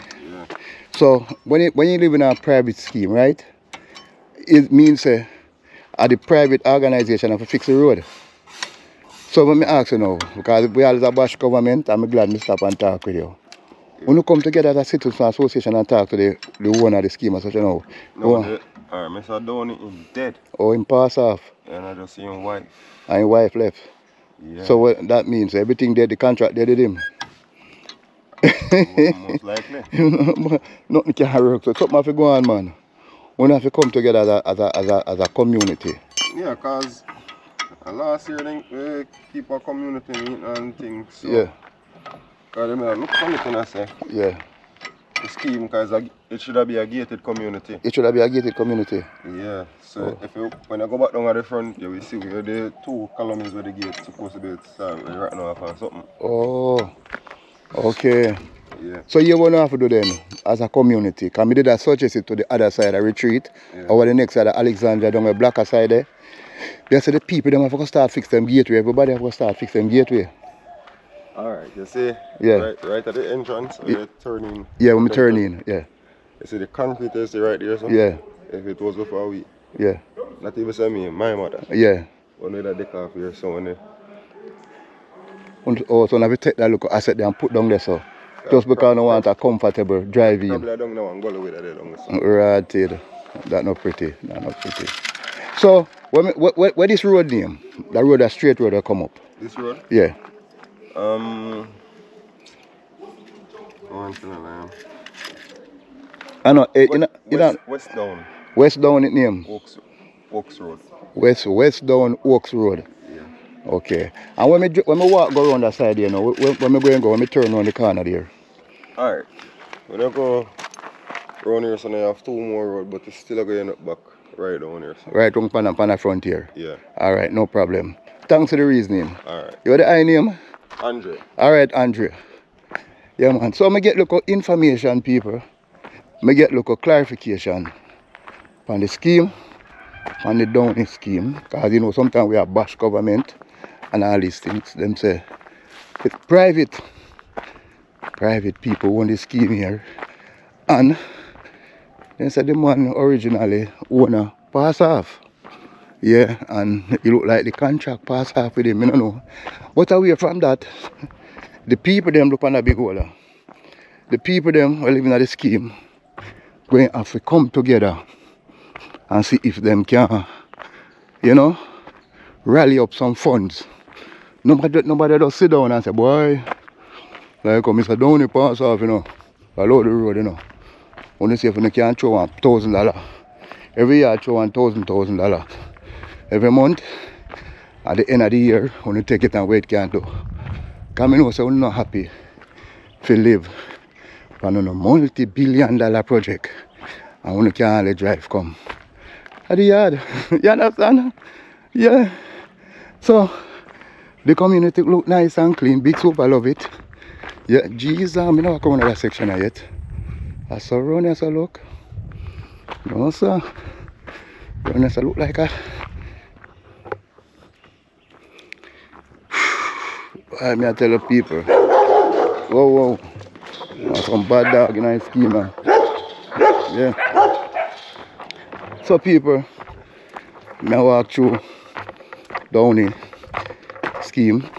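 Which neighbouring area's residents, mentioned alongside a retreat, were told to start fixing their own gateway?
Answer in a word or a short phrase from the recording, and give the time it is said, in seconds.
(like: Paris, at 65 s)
Alexandria, at 64 s.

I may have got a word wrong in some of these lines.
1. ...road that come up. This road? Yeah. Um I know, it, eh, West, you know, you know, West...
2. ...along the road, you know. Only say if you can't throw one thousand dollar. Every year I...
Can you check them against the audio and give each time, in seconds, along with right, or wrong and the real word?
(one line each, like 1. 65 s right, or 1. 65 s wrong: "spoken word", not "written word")
1. 98 s right
2. 179 s right.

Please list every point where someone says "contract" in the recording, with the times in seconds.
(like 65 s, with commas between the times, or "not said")
26 s, 157 s.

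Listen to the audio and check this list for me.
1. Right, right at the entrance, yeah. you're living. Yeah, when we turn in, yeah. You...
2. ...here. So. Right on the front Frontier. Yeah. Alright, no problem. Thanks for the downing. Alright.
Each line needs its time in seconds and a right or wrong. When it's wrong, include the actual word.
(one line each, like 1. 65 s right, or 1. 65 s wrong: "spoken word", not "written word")
1. 72 s wrong: "turning", not "living"
2. 124 s wrong: "reasoning", not "downing".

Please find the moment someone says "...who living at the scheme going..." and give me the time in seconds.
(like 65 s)
164 s.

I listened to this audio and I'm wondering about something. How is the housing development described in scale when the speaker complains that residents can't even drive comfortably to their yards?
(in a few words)
Multi-billion dollar project.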